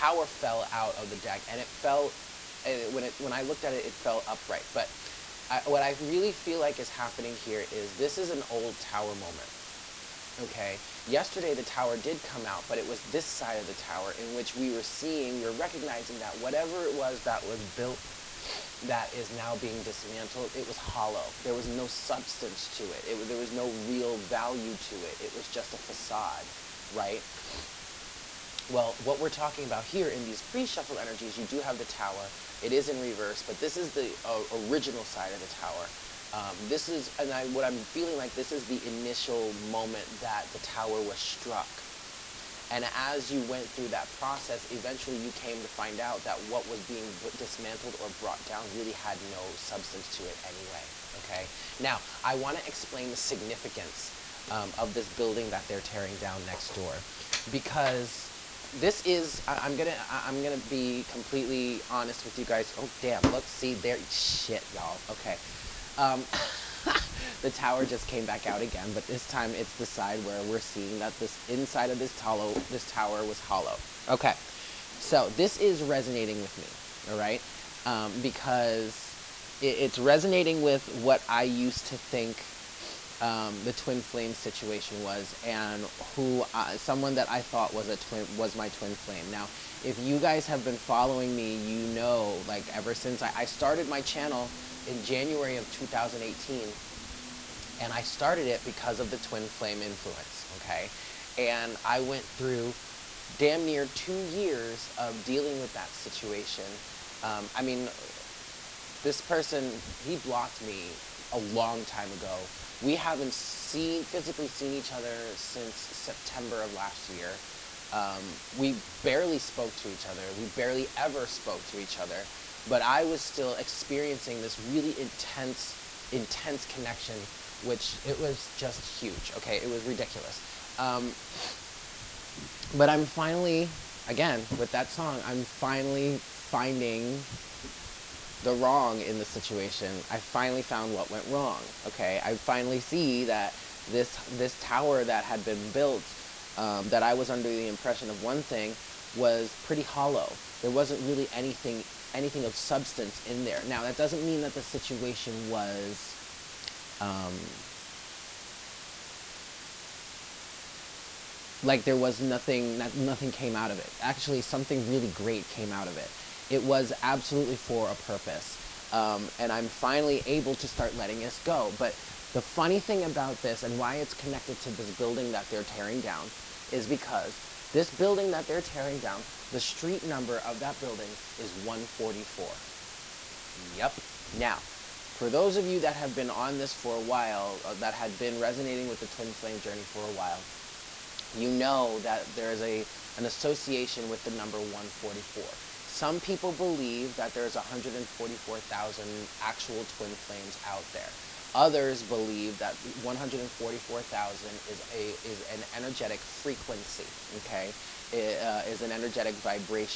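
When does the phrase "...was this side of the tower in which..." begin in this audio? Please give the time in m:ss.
0:12.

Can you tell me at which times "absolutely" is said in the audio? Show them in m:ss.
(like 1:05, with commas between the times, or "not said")
2:47.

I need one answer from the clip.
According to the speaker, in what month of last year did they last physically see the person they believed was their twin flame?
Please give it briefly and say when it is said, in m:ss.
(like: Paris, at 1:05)
September, at 1:55.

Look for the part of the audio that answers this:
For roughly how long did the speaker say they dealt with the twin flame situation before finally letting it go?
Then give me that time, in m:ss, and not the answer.
1:43.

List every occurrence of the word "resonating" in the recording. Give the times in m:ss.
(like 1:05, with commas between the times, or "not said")
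1:15, 1:19, 3:08.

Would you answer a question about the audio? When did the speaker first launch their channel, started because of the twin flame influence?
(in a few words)
January 2018.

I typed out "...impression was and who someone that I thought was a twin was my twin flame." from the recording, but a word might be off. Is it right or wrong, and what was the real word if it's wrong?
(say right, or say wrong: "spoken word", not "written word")
wrong: "situation", not "impression".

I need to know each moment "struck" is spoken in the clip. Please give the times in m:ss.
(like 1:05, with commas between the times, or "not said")
0:41.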